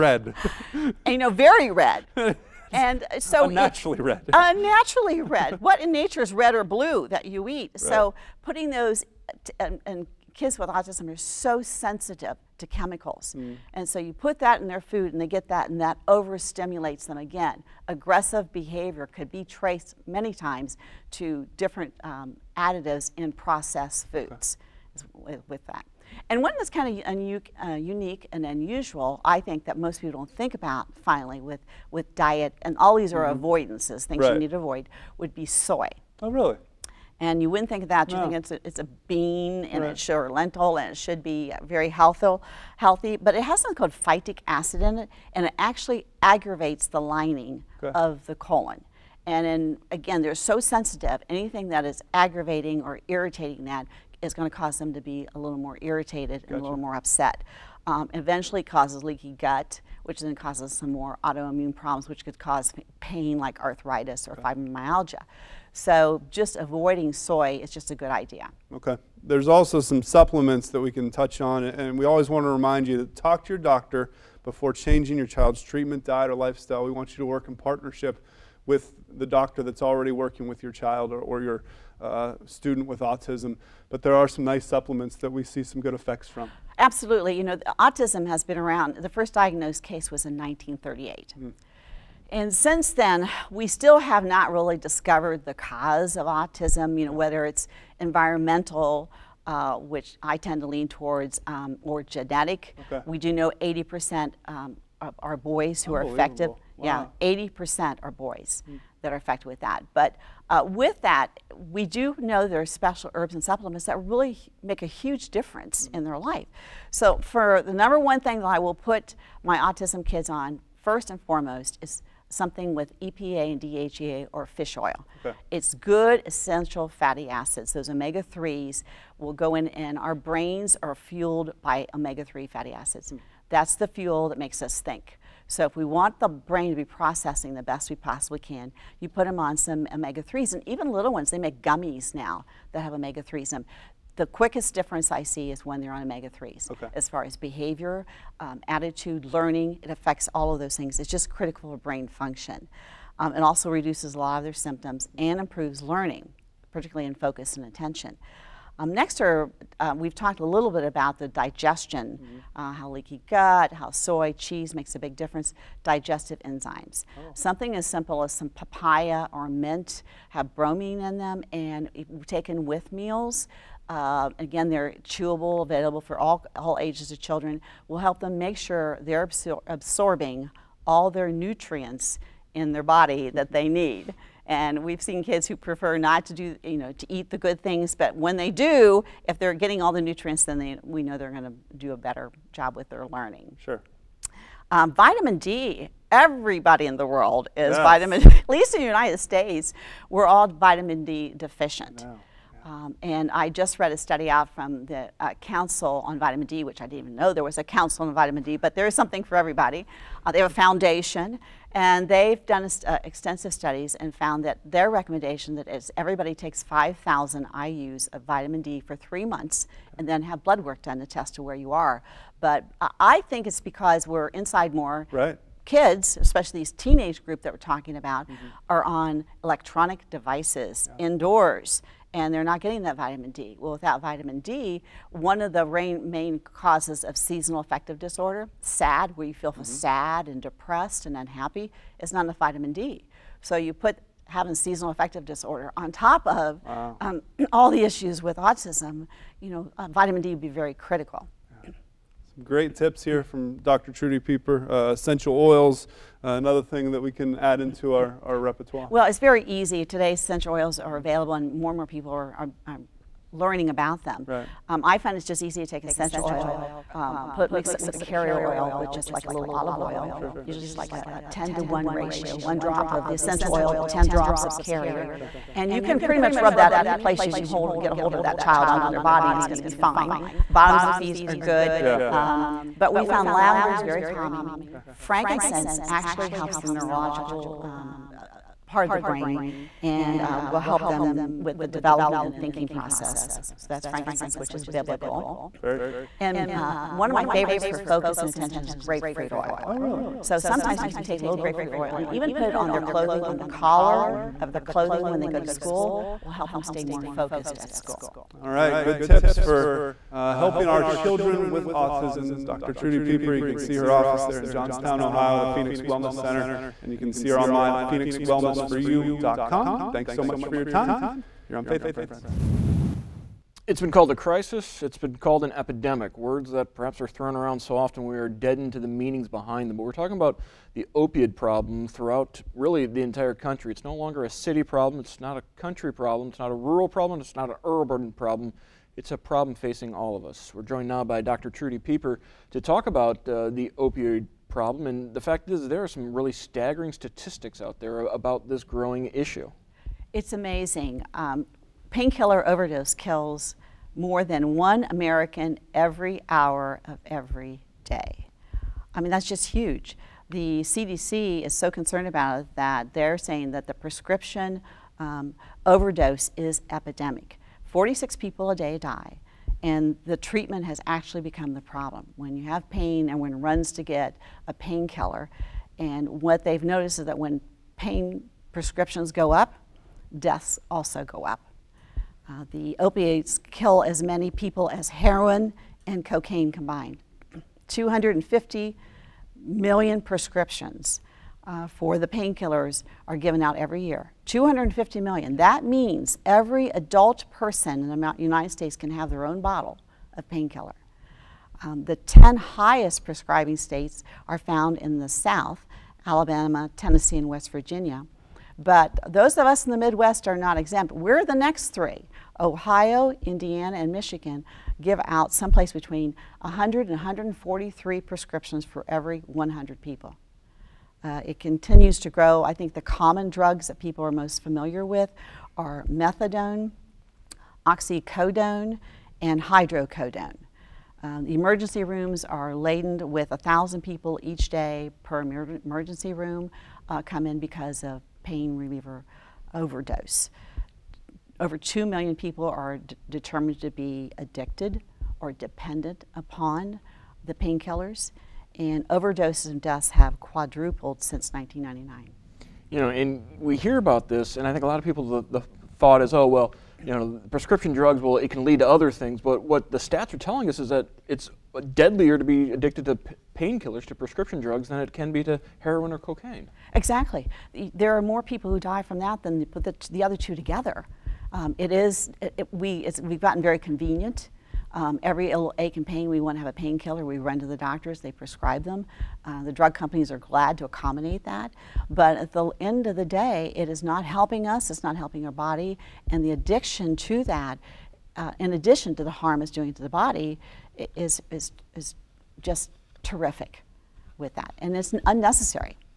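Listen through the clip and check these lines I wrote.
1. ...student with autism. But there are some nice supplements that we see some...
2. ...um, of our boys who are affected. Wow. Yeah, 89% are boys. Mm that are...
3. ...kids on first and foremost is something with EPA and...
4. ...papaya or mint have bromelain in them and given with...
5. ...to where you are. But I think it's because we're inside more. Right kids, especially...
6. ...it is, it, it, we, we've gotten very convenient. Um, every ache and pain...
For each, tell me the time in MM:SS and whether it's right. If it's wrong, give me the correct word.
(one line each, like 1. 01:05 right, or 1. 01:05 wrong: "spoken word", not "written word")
1. 01:22 right
2. 01:44 wrong: "80", not "89"
3. 02:00 right
4. 02:48 wrong: "taken", not "given"
5. 03:41 right
6. 07:51 right.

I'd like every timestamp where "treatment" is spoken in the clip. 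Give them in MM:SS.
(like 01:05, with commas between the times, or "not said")
01:15, 06:10.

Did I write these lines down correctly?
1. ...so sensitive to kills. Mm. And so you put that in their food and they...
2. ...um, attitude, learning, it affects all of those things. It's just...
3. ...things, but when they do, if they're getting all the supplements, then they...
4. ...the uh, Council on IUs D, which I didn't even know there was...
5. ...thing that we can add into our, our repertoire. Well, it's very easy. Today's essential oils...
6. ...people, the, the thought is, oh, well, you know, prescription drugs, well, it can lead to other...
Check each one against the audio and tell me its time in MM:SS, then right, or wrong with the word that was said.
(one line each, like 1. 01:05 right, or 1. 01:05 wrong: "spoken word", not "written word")
1. 00:11 wrong: "chemicals", not "kills"
2. 02:28 right
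3. 03:07 wrong: "nutrients", not "supplements"
4. 03:24 wrong: "Vitamin", not "IUs"
5. 04:16 right
6. 07:34 right.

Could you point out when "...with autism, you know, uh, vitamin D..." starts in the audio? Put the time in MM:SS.
04:08.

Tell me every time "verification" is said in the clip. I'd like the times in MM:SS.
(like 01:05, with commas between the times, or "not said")
not said.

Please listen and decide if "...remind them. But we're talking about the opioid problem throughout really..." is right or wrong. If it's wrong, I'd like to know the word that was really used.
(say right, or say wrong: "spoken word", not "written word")
wrong: "behind", not "remind".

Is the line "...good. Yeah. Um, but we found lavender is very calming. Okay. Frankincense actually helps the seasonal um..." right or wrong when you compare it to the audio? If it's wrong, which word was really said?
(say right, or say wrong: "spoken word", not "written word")
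wrong: "neurological", not "seasonal".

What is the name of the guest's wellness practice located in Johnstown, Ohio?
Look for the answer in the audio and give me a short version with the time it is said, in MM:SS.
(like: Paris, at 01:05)
Phoenix Wellness Center, at 05:15.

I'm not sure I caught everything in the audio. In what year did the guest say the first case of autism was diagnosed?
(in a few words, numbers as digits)
1938.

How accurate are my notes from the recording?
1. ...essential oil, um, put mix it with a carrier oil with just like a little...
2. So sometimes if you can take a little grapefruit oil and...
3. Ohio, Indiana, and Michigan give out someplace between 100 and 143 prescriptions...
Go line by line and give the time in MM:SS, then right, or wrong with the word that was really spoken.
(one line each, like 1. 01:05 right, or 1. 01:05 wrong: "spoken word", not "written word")
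1. 04:25 right
2. 05:00 right
3. 06:52 right.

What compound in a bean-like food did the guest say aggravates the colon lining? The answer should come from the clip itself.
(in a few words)
phytic acid.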